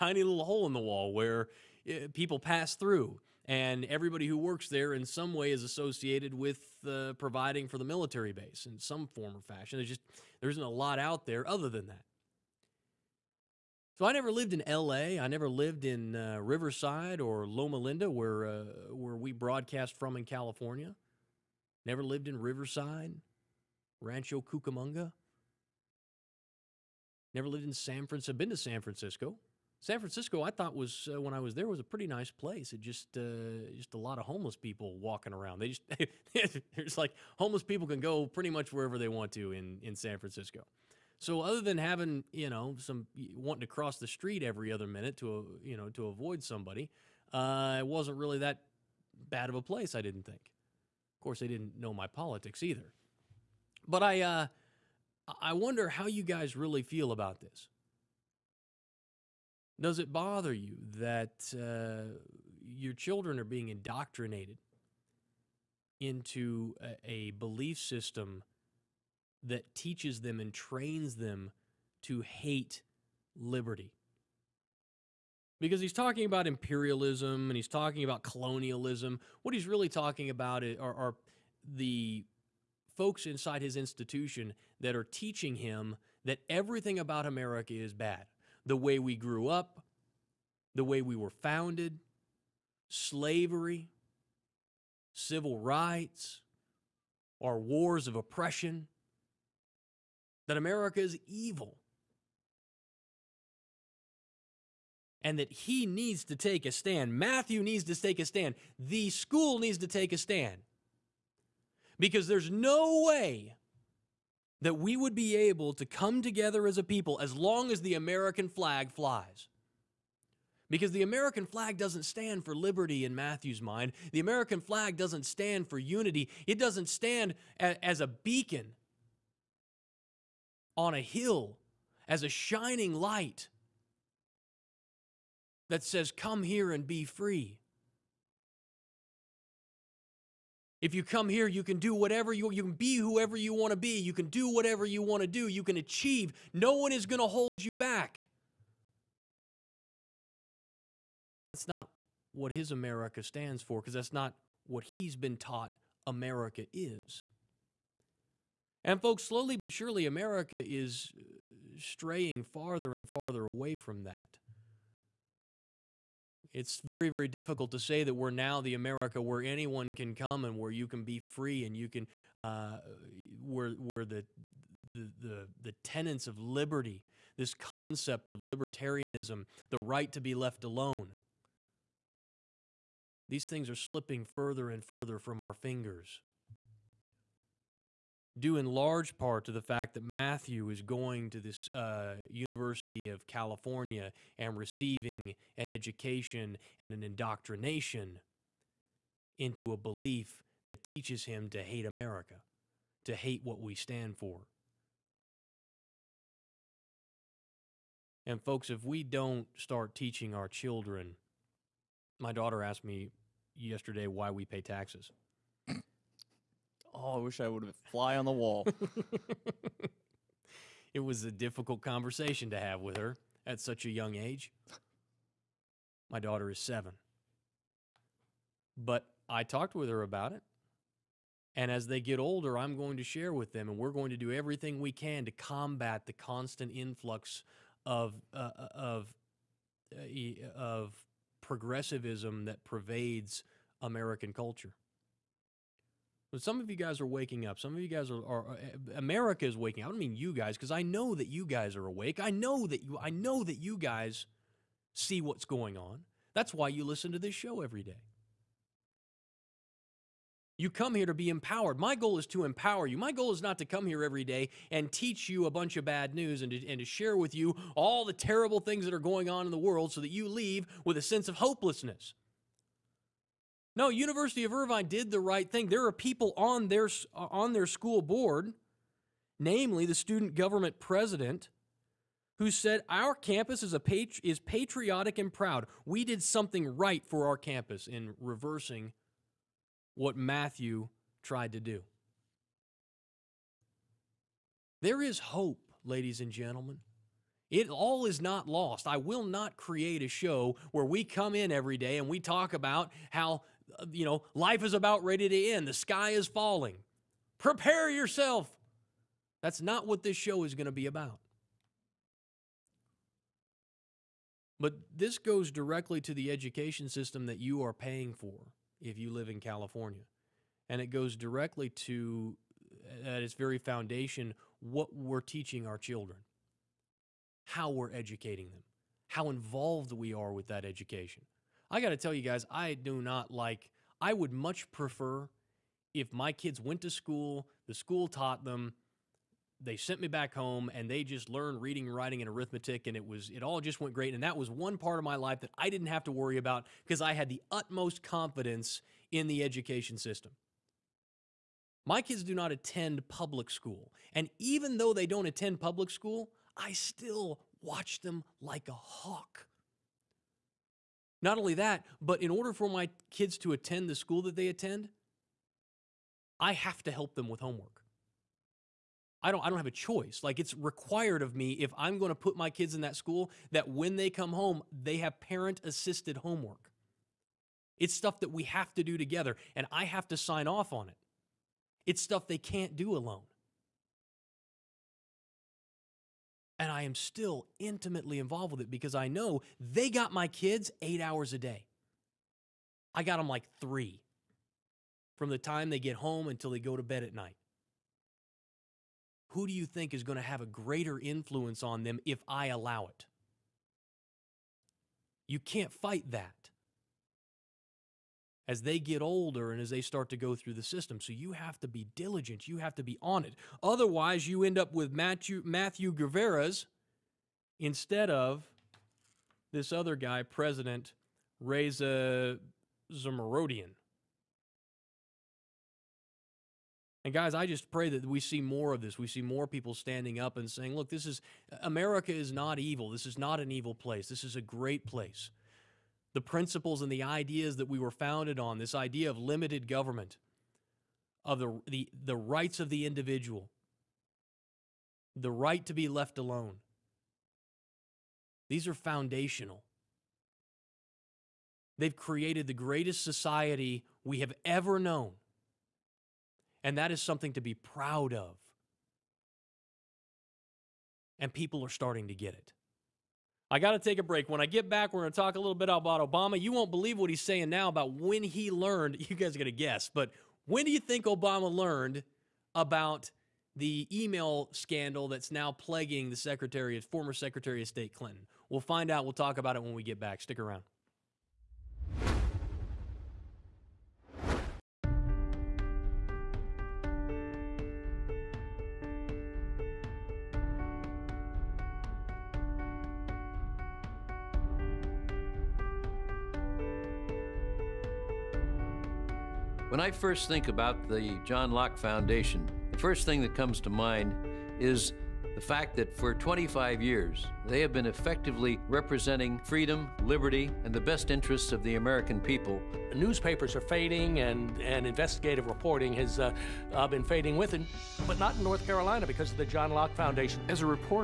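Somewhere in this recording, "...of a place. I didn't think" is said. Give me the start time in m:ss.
0:49.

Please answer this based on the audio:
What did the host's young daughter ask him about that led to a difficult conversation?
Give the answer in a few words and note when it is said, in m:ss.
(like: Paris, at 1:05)
why we pay taxes, at 3:34.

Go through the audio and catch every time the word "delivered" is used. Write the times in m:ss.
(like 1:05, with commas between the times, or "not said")
not said.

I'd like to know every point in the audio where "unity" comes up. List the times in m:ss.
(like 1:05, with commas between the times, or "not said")
2:05.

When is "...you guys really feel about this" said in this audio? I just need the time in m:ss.
0:56.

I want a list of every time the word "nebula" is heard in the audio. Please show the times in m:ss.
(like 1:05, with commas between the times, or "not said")
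not said.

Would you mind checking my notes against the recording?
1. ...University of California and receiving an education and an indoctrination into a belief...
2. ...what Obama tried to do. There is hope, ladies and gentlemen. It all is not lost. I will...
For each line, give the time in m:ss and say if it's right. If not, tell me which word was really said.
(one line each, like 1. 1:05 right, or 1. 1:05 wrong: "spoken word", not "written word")
1. 3:12 right
2. 4:49 wrong: "Matthew", not "Obama".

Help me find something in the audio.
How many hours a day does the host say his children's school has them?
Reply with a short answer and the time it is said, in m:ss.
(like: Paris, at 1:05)
8, at 6:30.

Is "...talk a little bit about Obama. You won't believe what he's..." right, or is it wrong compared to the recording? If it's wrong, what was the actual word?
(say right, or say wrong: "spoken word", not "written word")
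right.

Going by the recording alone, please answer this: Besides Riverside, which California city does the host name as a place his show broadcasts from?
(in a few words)
Loma Linda.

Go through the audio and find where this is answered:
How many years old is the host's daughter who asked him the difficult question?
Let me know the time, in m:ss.
3:46.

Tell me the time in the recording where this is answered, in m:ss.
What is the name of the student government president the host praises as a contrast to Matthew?
7:01.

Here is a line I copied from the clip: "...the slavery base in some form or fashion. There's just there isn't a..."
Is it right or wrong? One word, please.
wrong.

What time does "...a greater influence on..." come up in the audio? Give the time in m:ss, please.
6:40.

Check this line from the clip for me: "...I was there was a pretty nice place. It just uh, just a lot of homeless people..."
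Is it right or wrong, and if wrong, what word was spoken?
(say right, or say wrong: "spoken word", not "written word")
right.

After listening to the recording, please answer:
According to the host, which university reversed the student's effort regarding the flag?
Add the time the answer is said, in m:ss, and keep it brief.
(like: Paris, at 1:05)
University of Irvine, at 4:33.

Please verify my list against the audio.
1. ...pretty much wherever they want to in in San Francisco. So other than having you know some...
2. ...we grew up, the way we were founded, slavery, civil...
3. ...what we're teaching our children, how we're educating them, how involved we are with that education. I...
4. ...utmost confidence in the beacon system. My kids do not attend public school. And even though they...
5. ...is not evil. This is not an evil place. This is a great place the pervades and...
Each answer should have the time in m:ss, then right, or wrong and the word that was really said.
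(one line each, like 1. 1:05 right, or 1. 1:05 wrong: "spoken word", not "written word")
1. 0:38 right
2. 1:28 right
3. 5:24 right
4. 5:47 wrong: "education", not "beacon"
5. 7:12 wrong: "principles", not "pervades".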